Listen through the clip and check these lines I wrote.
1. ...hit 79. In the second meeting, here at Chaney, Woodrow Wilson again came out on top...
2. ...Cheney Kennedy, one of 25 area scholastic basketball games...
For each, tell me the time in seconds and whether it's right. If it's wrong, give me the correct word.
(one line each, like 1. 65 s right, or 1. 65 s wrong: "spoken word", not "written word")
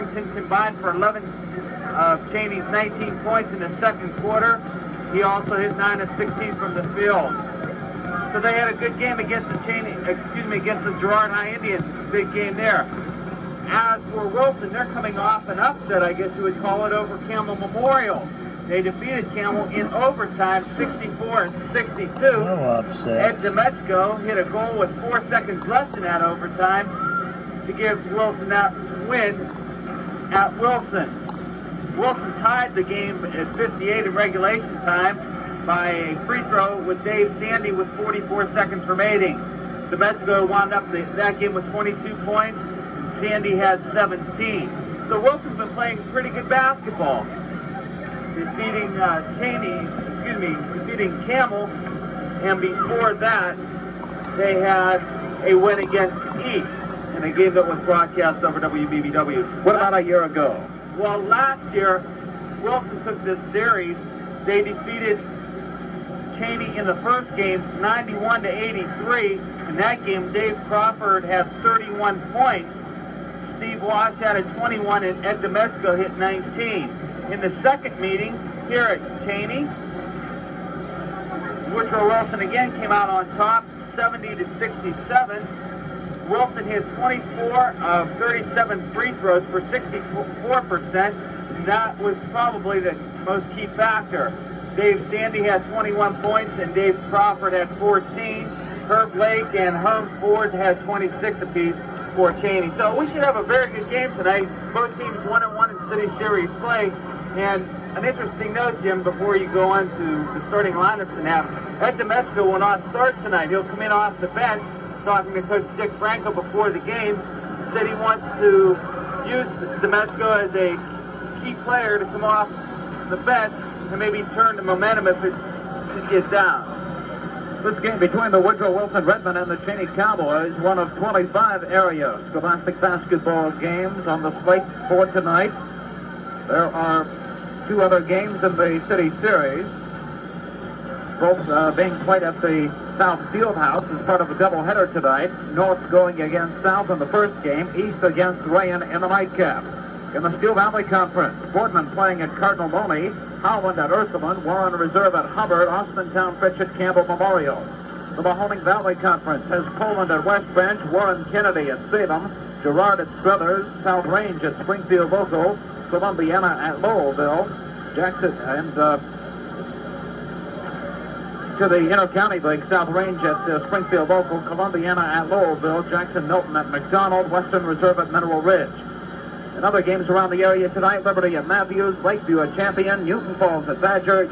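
1. 75 s wrong: "19", not "79"
2. 129 s wrong: "Cowboys", not "Kennedy".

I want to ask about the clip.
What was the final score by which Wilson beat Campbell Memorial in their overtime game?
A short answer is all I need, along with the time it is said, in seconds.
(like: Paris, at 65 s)
64-62, at 20 s.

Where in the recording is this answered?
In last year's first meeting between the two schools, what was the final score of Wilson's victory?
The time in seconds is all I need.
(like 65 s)
67 s.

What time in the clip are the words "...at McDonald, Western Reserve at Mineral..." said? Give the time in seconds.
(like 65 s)
176 s.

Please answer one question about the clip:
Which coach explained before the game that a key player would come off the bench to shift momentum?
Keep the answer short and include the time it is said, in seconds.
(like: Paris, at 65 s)
Dick Franco, at 115 s.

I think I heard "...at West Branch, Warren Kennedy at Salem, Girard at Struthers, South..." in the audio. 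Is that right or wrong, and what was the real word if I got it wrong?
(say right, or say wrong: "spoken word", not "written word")
right.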